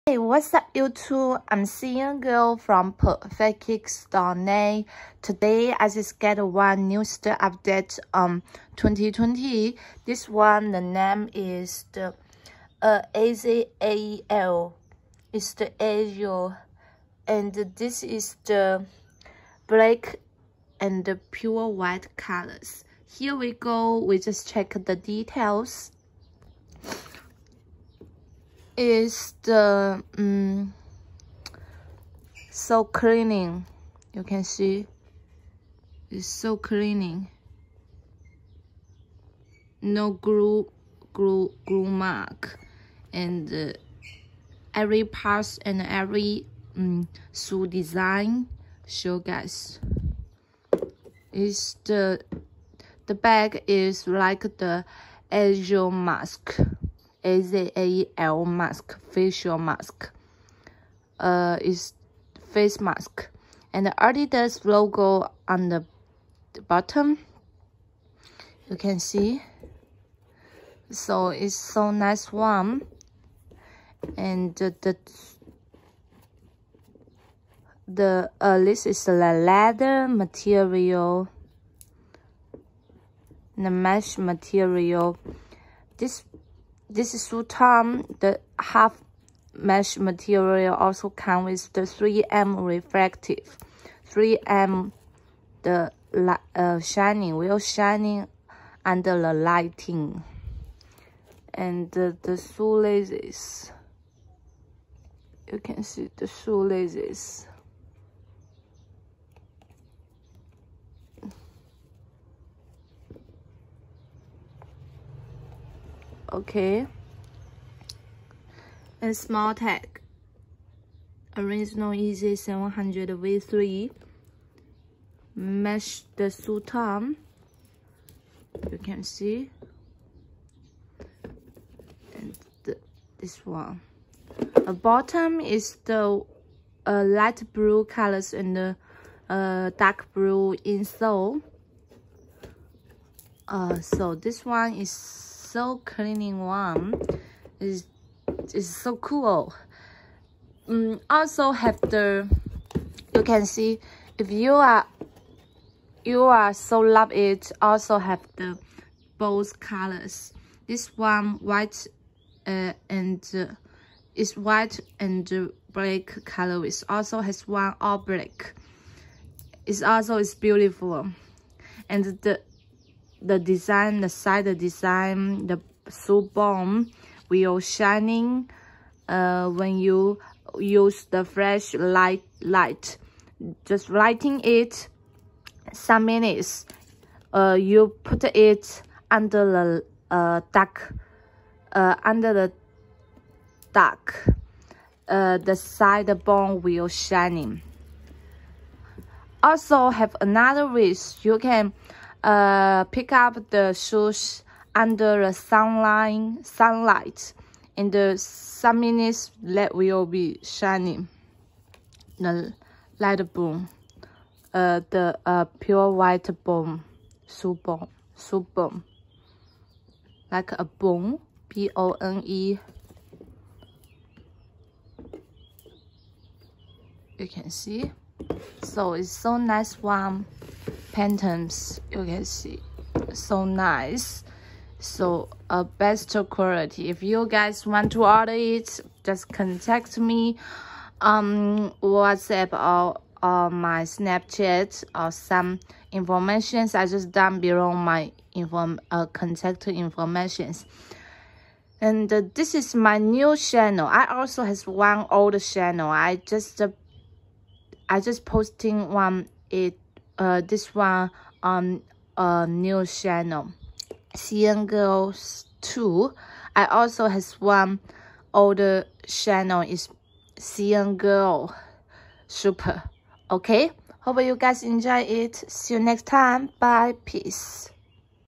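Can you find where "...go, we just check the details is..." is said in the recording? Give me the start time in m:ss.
0:23.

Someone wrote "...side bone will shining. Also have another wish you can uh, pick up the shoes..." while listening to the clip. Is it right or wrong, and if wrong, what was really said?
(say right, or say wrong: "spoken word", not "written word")
right.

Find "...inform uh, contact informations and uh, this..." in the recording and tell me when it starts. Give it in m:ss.
4:08.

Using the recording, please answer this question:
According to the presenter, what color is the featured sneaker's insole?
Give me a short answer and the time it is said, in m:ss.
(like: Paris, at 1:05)
Dark blue, at 2:19.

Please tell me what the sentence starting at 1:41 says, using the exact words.
And uh, the shoelaces, you can see the shoelaces.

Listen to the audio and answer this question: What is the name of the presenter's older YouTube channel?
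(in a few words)
CN Girl Super.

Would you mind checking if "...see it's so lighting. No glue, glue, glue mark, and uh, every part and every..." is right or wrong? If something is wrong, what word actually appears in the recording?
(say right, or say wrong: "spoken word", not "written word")
wrong: "cleaning", not "lighting".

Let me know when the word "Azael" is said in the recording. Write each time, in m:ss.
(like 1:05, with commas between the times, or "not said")
0:13, 0:57.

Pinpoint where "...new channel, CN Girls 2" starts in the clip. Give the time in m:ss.
4:22.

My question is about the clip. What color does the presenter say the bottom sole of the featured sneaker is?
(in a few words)
Light blue.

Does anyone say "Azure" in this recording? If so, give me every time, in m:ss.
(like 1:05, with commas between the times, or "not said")
0:15, 0:55.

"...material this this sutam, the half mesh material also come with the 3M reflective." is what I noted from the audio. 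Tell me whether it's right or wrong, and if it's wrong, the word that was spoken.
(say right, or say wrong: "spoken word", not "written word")
right.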